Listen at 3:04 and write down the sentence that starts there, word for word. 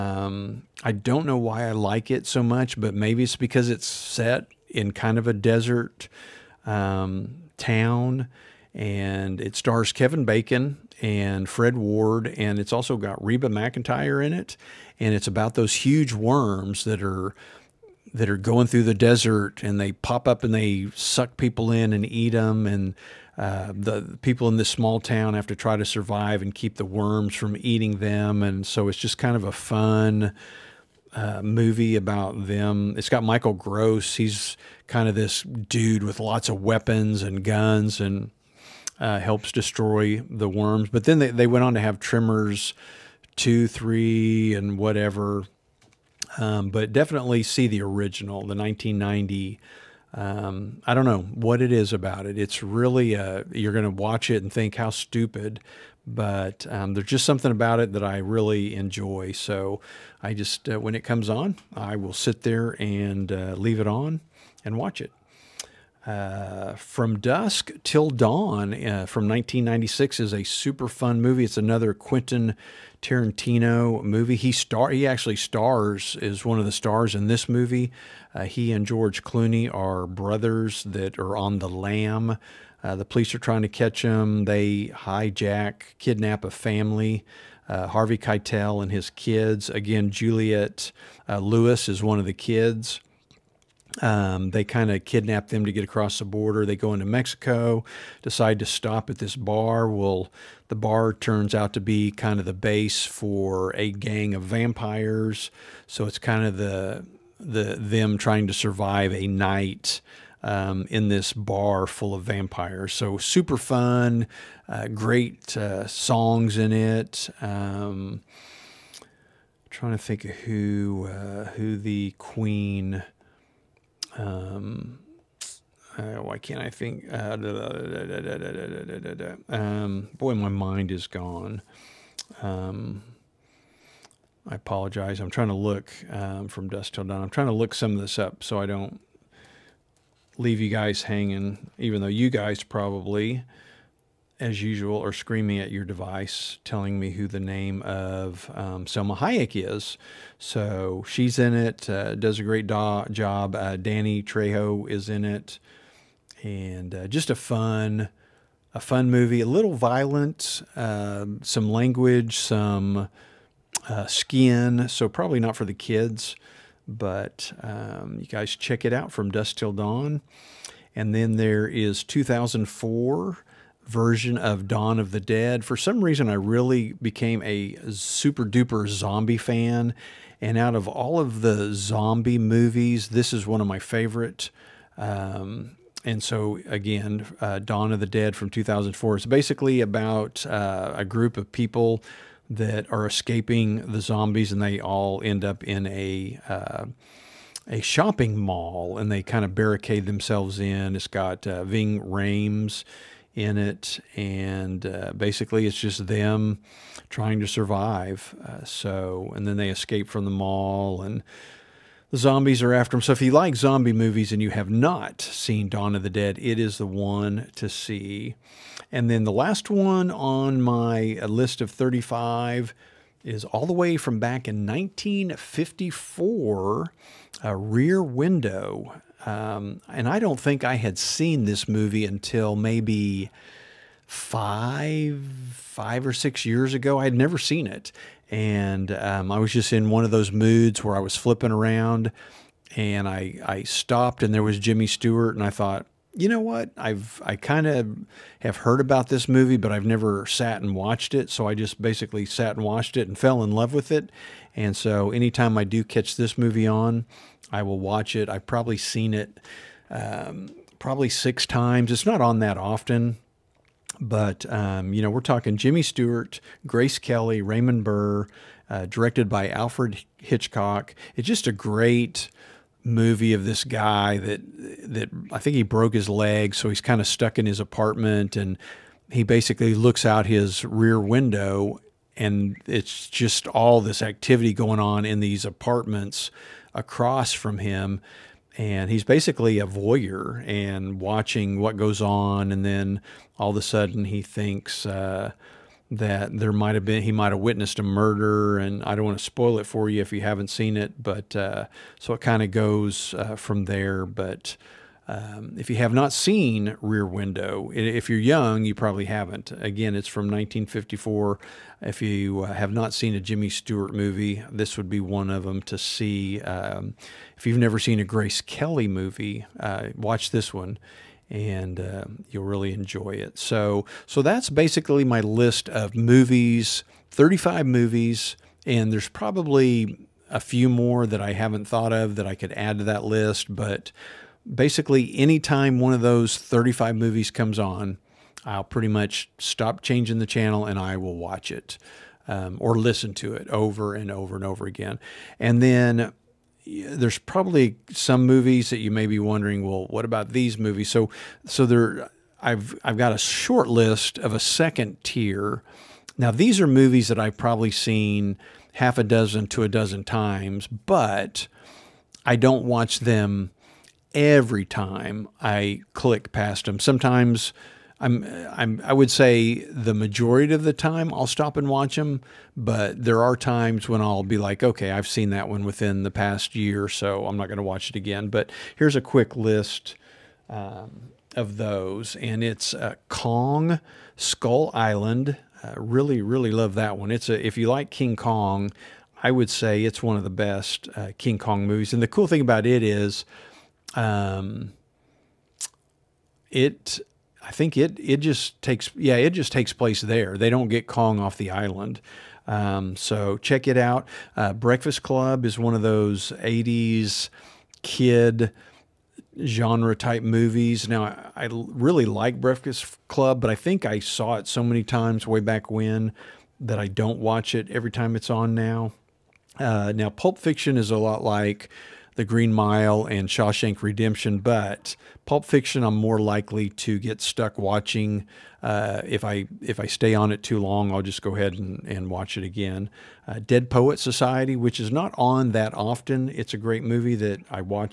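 Um, and so, again, uh, Dawn of the Dead from 2004.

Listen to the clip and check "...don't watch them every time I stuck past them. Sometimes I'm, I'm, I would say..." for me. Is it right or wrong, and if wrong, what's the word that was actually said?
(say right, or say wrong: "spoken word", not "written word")
wrong: "click", not "stuck".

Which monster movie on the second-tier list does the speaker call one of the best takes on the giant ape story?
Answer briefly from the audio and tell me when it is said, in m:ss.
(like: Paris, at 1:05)
Kong: Skull Island, at 6:23.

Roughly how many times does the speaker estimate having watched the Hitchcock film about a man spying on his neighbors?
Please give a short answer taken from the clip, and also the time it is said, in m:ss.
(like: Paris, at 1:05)
6, at 4:21.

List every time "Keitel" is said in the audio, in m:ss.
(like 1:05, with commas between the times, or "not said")
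1:28.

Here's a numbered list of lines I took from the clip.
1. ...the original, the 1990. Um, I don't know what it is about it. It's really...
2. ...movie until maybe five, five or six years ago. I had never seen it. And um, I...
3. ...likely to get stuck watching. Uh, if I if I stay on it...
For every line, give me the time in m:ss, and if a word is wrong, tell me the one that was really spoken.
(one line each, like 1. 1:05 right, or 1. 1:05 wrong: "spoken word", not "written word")
1. 0:47 right
2. 3:51 right
3. 7:06 right.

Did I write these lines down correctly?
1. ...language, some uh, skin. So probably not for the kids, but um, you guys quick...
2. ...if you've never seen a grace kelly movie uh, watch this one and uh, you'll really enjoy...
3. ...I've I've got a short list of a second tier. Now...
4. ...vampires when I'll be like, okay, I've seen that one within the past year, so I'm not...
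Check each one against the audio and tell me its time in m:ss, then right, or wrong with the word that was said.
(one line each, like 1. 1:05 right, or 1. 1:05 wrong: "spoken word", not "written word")
1. 2:41 wrong: "check", not "quick"
2. 5:17 right
3. 5:52 right
4. 6:13 wrong: "times", not "vampires".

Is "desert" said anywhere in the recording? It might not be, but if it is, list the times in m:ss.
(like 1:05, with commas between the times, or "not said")
0:05, 0:18.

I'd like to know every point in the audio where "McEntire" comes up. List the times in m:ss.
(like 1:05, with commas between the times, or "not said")
0:13.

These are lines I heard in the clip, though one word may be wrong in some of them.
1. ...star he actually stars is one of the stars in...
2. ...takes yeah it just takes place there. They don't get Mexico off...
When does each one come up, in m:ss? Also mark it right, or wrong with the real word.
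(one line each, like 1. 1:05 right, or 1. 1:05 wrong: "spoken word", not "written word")
1. 1:14 right
2. 6:38 wrong: "Kong", not "Mexico".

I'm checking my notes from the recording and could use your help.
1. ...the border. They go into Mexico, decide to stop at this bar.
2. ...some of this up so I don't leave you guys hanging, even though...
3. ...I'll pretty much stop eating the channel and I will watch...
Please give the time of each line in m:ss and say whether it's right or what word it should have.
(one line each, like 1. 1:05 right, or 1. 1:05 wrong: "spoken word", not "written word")
1. 1:36 right
2. 2:17 right
3. 5:38 wrong: "changing", not "eating".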